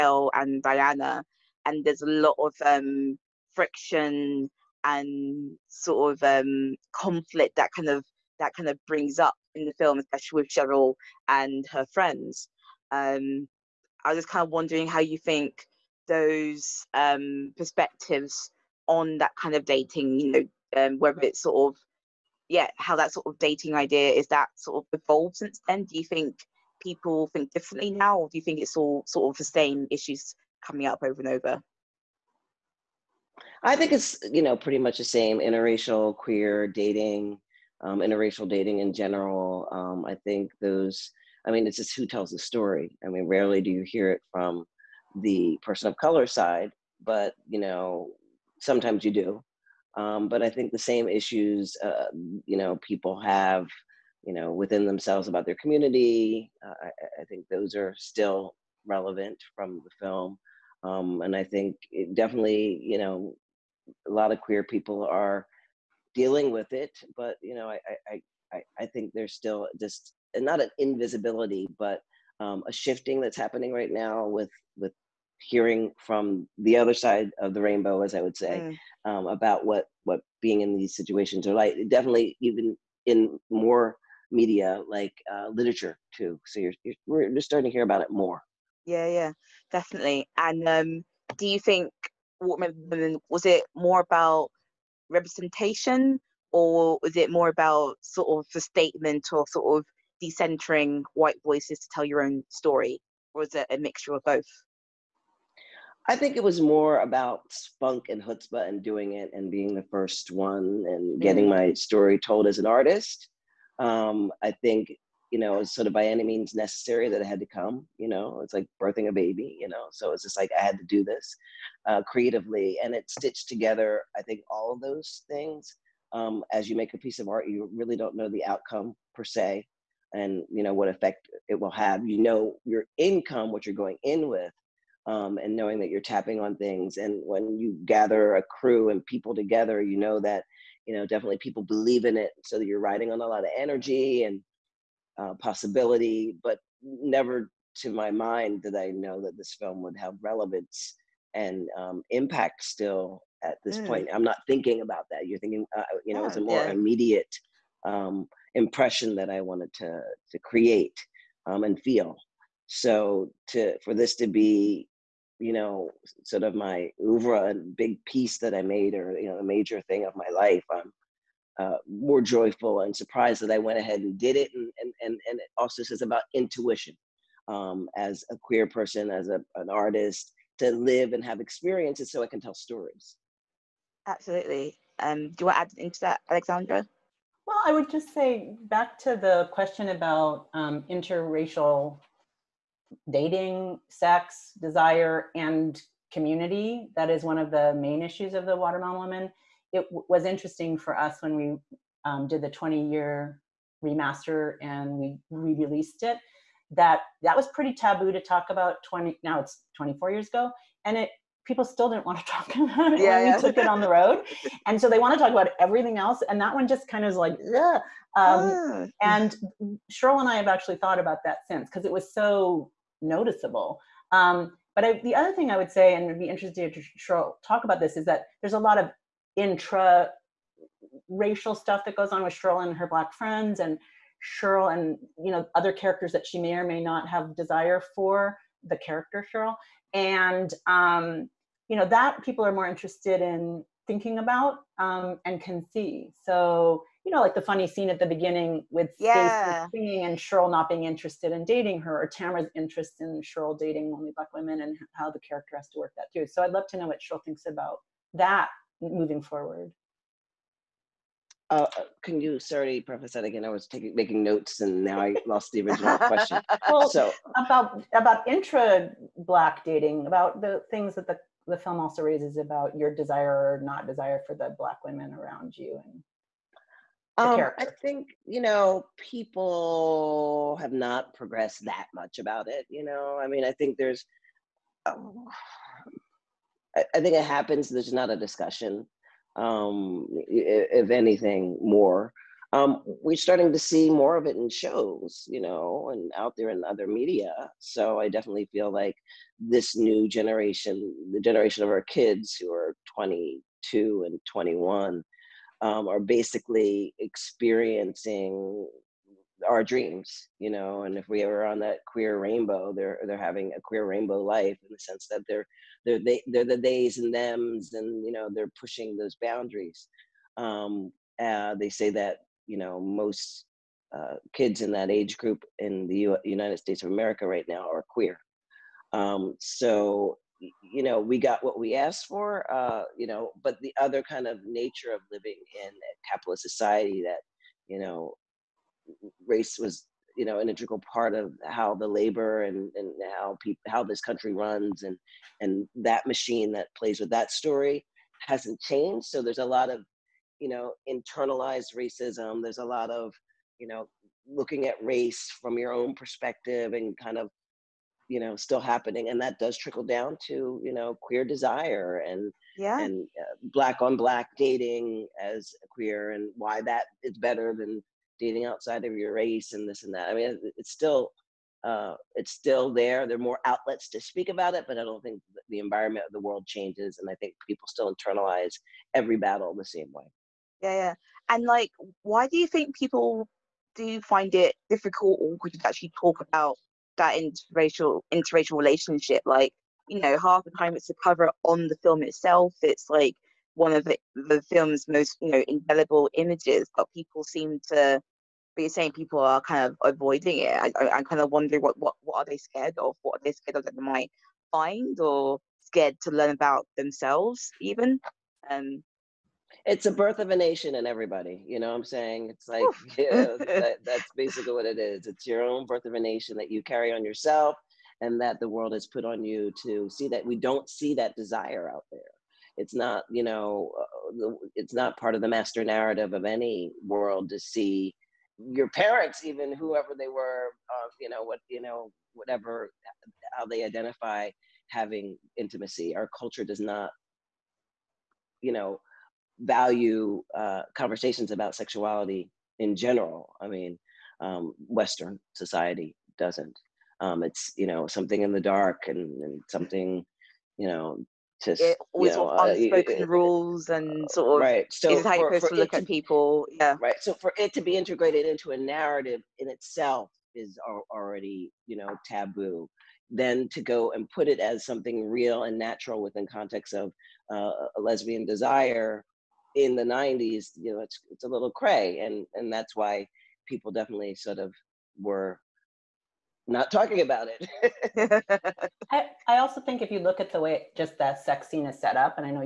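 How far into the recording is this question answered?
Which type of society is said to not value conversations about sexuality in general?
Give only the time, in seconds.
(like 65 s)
444 s.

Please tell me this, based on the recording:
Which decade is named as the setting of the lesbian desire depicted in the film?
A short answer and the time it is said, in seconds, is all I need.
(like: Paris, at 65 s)
the 90s, at 469 s.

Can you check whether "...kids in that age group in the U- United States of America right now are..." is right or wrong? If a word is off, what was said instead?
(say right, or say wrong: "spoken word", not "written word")
right.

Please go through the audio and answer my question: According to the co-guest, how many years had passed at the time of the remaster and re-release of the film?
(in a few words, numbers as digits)
20.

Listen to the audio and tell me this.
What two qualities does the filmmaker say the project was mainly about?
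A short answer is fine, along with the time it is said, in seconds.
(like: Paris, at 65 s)
spunk and chutzpah, at 107 s.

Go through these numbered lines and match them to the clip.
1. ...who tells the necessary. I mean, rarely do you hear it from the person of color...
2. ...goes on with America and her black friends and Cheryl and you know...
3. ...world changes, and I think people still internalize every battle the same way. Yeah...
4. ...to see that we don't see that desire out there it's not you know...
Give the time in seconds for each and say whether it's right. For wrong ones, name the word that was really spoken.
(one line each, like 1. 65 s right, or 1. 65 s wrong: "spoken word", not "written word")
1. 41 s wrong: "story", not "necessary"
2. 231 s wrong: "Cheryl", not "America"
3. 376 s right
4. 419 s right.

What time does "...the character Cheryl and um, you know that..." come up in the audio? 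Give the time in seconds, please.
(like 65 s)
238 s.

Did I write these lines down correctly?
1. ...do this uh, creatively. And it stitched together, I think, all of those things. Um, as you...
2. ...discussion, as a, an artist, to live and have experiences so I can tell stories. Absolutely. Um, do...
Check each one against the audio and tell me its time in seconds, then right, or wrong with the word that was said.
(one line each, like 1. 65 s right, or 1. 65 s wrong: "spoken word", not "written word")
1. 120 s right
2. 178 s wrong: "person", not "discussion".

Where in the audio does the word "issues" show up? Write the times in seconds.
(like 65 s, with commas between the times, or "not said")
29 s, 51 s, 198 s.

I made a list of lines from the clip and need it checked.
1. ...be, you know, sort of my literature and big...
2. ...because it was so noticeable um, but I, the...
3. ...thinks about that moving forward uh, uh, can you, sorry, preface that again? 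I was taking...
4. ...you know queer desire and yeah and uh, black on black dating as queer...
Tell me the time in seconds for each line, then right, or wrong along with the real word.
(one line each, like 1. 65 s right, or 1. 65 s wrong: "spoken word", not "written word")
1. 164 s wrong: "oeuvre", not "literature"
2. 221 s right
3. 257 s right
4. 360 s right.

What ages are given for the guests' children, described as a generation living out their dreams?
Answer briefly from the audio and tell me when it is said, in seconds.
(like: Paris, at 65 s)
22 and 21, at 302 s.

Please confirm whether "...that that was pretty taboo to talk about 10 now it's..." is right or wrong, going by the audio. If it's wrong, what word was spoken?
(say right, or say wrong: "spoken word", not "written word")
wrong: "20", not "10".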